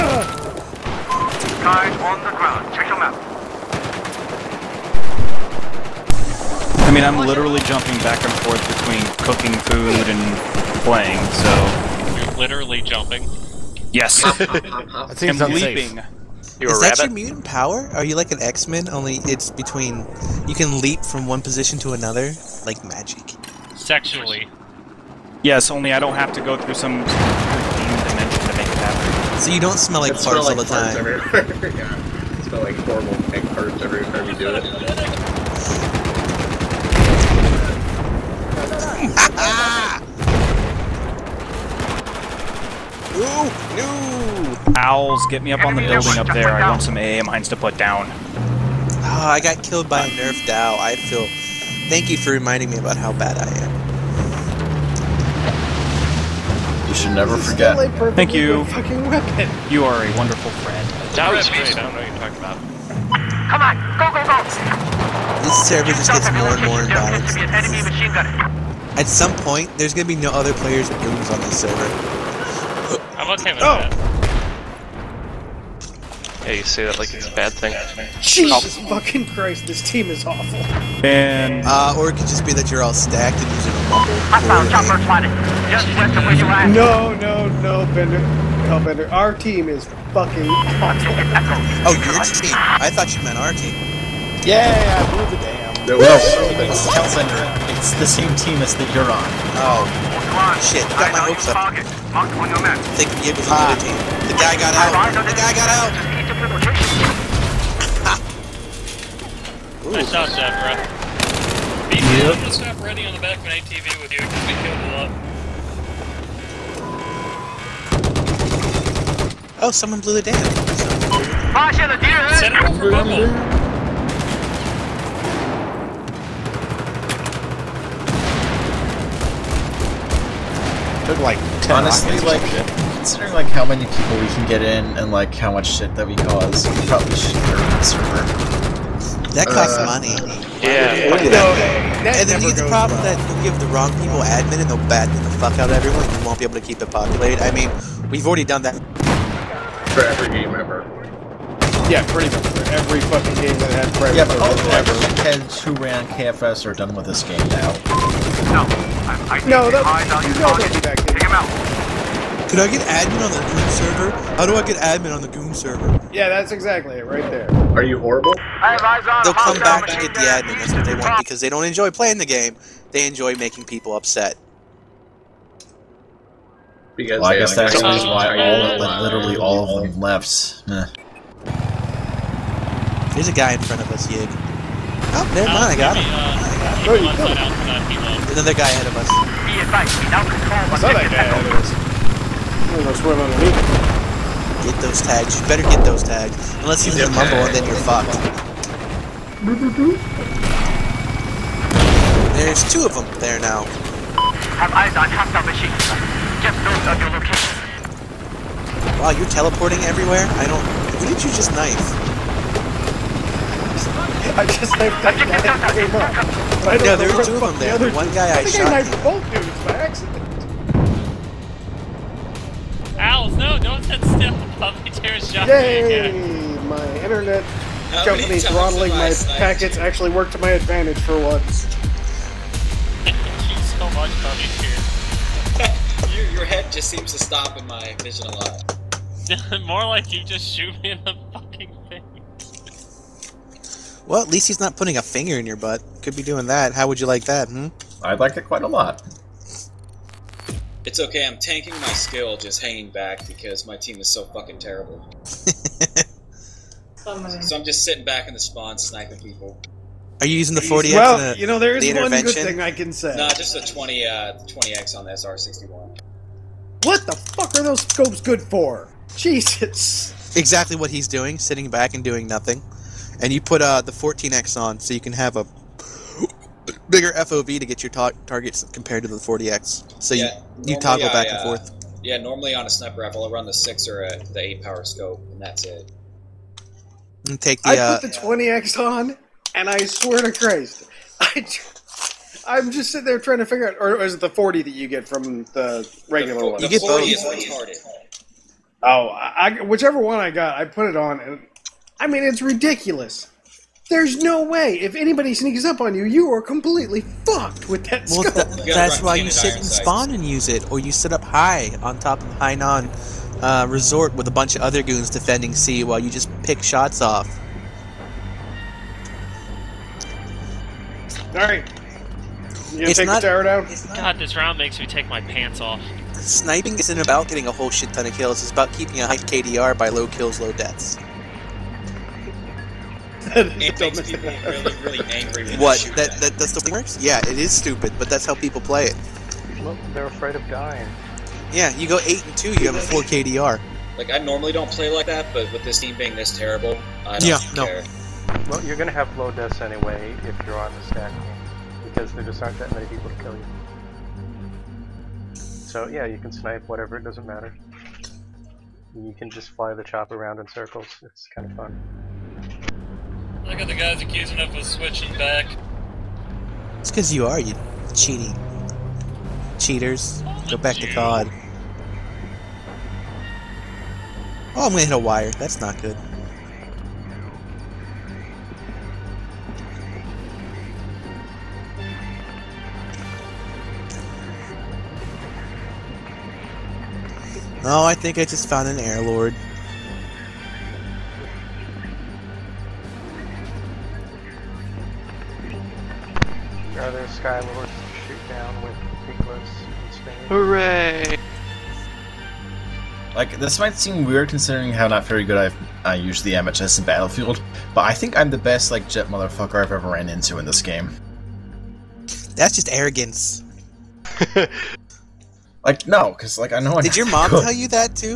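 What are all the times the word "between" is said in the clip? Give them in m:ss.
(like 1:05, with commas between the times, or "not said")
0:08, 0:19.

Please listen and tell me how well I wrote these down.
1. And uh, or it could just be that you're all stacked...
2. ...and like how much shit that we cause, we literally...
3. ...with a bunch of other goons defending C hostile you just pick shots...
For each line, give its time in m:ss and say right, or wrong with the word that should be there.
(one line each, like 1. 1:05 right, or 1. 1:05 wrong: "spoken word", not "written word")
1. 1:21 right
2. 2:14 wrong: "probably", not "literally"
3. 5:14 wrong: "while", not "hostile".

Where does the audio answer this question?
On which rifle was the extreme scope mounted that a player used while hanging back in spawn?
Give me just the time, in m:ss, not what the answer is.
4:25.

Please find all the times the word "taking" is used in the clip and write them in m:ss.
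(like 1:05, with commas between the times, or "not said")
not said.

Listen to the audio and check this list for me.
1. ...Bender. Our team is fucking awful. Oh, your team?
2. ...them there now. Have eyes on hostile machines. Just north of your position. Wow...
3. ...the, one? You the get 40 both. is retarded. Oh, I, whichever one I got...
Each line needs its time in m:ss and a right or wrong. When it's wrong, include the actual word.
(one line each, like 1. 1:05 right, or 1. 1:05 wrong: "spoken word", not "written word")
1. 1:28 right
2. 3:22 wrong: "location", not "position"
3. 4:56 right.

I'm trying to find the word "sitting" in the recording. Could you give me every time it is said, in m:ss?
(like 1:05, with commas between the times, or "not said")
4:17, 4:31, 4:52.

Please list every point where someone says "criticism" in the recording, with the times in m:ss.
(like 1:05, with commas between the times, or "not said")
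not said.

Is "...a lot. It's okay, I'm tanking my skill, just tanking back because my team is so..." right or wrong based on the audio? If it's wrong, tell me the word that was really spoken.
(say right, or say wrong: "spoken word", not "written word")
wrong: "hanging", not "tanking".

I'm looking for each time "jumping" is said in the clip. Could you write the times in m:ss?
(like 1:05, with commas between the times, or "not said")
0:07, 0:12.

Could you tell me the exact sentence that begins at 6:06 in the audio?
It's because you are, you cheating.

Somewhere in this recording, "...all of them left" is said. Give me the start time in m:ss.
2:59.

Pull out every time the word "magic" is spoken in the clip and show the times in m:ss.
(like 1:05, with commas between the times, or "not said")
0:22.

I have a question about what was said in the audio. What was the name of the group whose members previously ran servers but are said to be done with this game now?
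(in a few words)
KFS.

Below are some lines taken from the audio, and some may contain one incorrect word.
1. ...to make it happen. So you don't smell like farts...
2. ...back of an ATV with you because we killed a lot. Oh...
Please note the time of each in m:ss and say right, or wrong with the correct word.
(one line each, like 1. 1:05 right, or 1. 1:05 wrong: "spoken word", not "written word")
1. 0:28 right
2. 1:53 right.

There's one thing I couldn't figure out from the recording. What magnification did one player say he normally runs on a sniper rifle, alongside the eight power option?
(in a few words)
6.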